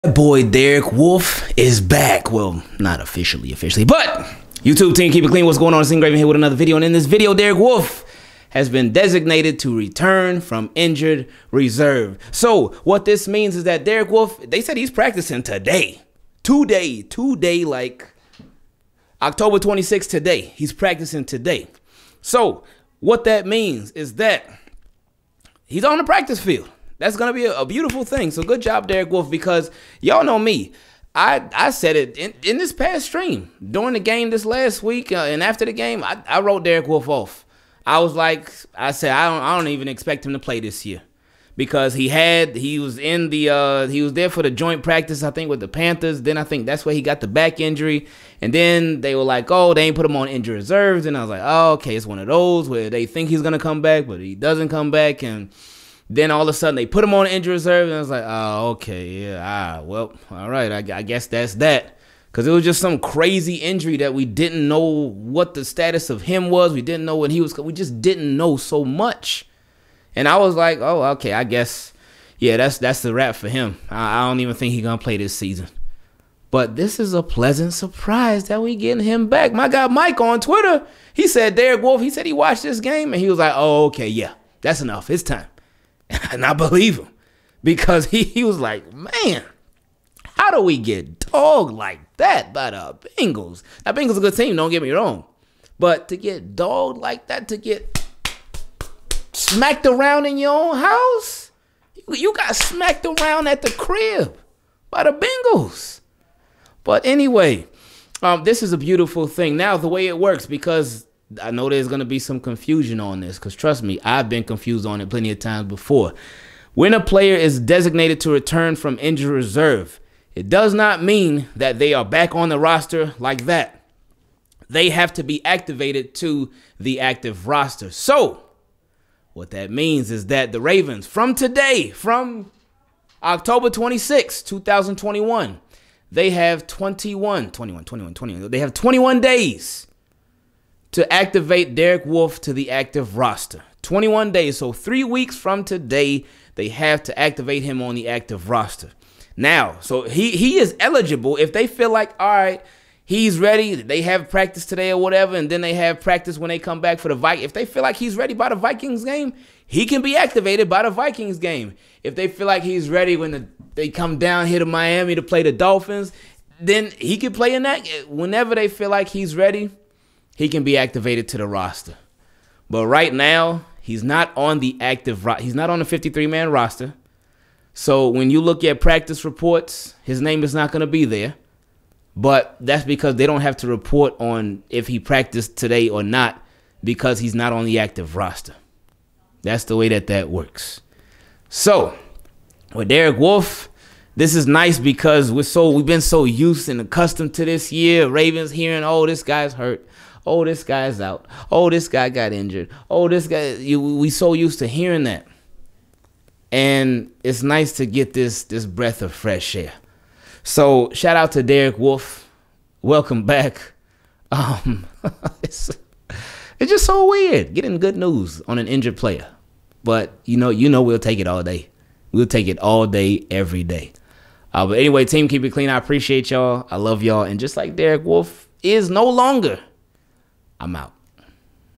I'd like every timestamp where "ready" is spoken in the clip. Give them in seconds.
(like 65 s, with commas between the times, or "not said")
153 s, 158 s, 162 s, 169 s.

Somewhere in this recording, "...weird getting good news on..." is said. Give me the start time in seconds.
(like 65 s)
217 s.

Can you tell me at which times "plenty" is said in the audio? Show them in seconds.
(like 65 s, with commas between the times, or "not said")
115 s.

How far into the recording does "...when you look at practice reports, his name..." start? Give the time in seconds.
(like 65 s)
178 s.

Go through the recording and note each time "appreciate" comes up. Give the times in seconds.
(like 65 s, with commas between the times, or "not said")
225 s.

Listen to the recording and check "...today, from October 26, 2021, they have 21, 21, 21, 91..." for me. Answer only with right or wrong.
wrong.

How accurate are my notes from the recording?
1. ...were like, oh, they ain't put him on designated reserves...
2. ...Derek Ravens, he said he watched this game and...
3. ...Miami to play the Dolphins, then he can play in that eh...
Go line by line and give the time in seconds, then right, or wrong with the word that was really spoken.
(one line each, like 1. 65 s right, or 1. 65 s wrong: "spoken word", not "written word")
1. 49 s wrong: "injured", not "designated"
2. 81 s wrong: "Wolfe", not "Ravens"
3. 164 s right.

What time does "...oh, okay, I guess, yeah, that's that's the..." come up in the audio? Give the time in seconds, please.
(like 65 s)
70 s.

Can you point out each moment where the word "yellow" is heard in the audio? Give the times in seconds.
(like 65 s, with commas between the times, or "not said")
not said.